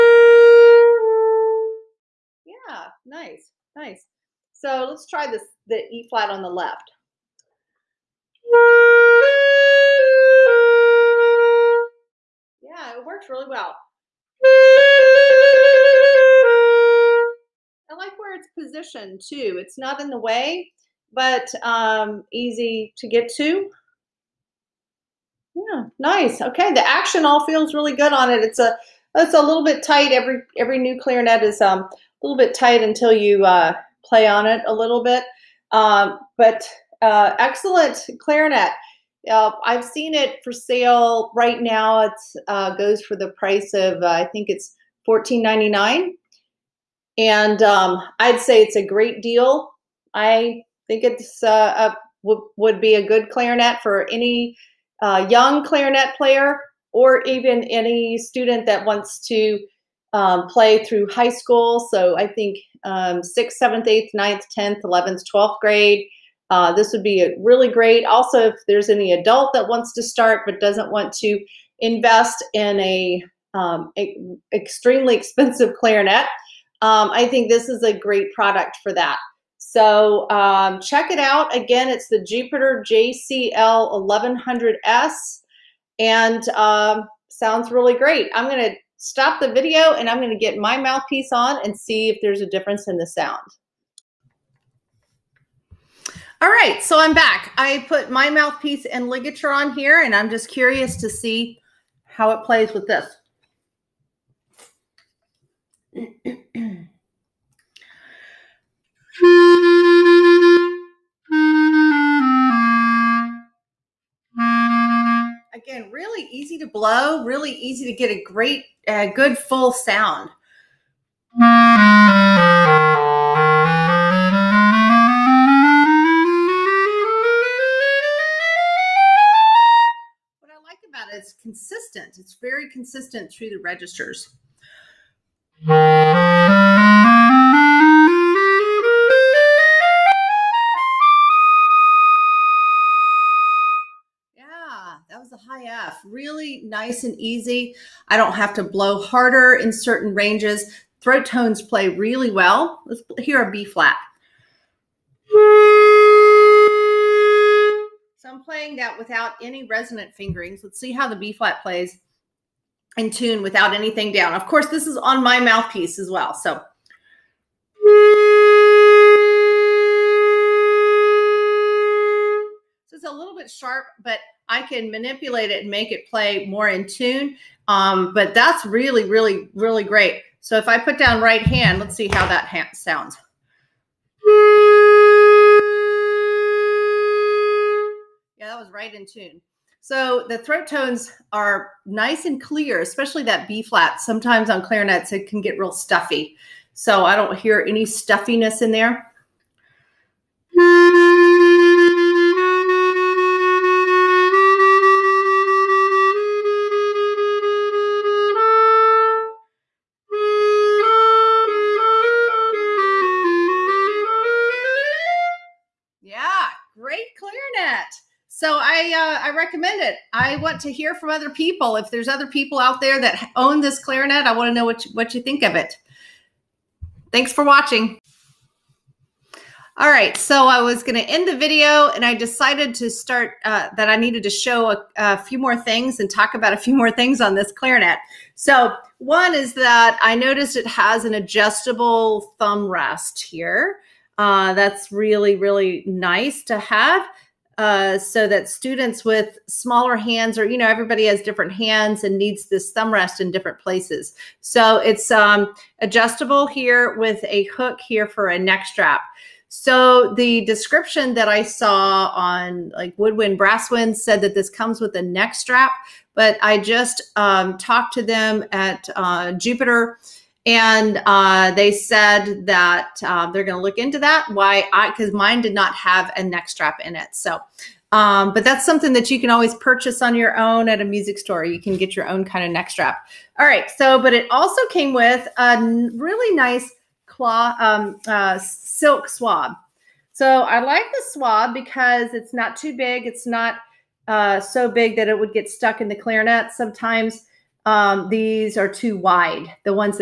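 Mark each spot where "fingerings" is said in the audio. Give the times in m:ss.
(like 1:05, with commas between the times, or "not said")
2:40.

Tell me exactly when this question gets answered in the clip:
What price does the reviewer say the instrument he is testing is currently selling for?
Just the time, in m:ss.
0:45.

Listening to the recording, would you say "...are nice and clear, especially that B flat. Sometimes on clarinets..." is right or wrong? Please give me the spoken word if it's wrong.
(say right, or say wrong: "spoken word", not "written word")
right.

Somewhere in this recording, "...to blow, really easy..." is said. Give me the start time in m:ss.
1:56.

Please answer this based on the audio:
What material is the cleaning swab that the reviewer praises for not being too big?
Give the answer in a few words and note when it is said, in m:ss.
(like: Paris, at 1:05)
Silk, at 4:48.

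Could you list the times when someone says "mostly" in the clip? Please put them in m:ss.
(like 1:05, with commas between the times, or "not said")
not said.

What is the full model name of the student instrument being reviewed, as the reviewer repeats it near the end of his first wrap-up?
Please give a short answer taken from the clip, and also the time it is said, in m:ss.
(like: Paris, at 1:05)
Jupiter JCL 1100S, at 1:22.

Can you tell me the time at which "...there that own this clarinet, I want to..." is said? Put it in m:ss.
3:42.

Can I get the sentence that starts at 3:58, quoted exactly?
So one is that I noticed it has an adjustable thumb rest here.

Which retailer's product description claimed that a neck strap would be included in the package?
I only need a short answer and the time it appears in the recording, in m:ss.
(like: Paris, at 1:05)
Woodwind Brasswind, at 4:22.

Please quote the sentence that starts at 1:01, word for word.
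So I think um, sixth, seventh, eighth, ninth, 10th, 11th, 12th grade.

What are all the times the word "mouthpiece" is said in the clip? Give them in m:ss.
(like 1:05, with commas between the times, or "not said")
1:30, 1:38, 2:45.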